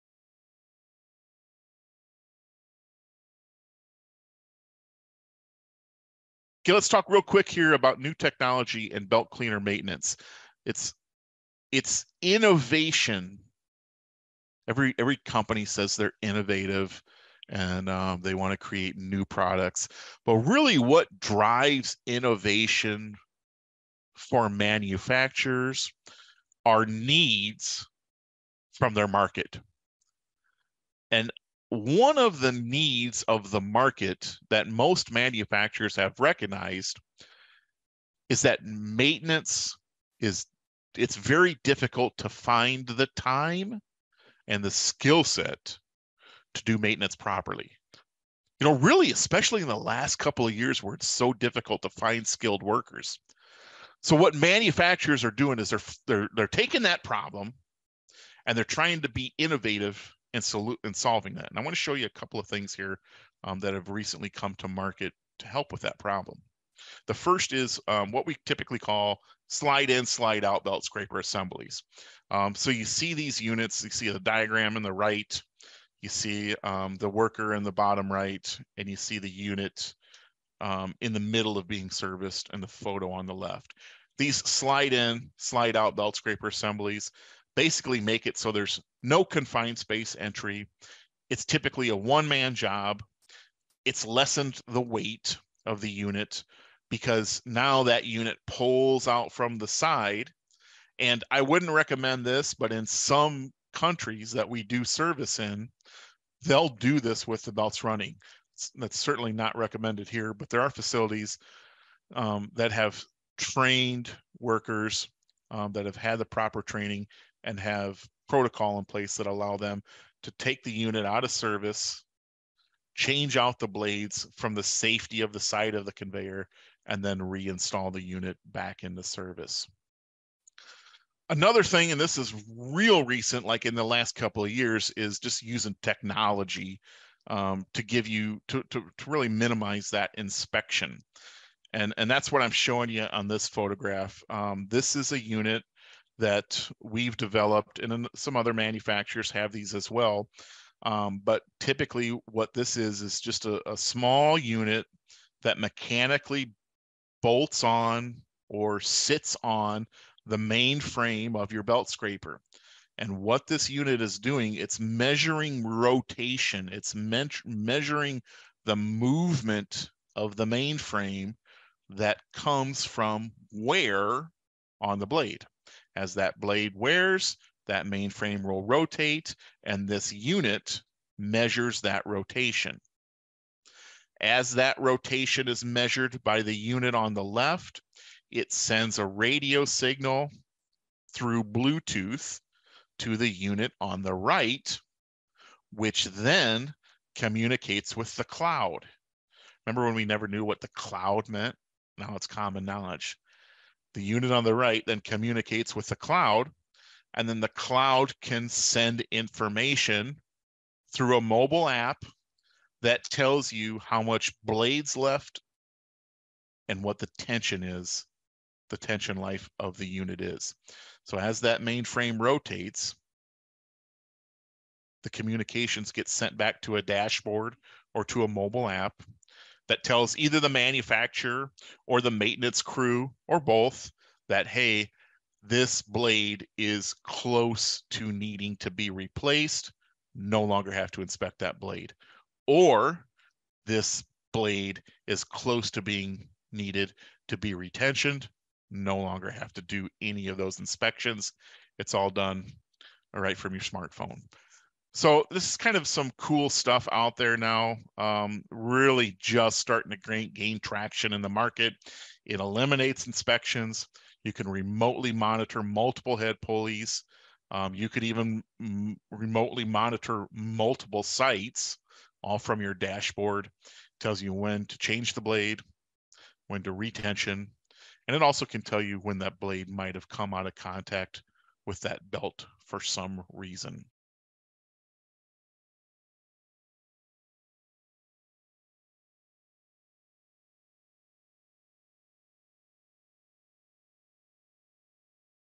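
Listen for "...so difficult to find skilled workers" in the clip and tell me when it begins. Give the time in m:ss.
0:51.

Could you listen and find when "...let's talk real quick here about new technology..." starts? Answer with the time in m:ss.
0:06.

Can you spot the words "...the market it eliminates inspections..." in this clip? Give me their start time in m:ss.
4:21.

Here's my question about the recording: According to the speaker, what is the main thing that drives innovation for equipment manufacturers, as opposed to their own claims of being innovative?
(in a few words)
Needs from their market.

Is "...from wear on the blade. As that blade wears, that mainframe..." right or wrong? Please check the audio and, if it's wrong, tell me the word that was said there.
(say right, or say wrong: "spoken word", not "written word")
right.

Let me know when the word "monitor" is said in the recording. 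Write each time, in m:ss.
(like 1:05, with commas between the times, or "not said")
4:25, 4:29.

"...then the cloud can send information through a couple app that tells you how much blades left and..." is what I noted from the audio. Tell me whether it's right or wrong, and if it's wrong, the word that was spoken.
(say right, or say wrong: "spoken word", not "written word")
wrong: "mobile", not "couple".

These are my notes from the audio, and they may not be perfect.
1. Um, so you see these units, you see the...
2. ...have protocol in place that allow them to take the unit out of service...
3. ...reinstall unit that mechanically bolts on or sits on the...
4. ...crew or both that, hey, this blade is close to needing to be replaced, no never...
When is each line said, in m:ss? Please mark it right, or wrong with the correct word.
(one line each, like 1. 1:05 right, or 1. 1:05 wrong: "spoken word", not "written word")
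1. 1:12 right
2. 1:57 right
3. 2:33 wrong: "small", not "reinstall"
4. 3:52 wrong: "longer", not "never".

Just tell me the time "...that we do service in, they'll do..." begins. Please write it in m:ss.
1:44.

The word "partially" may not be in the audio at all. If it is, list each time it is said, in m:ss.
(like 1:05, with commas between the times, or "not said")
not said.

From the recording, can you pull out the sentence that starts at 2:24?
Um, this is a unit that we've developed, and some other manufacturers have these as well.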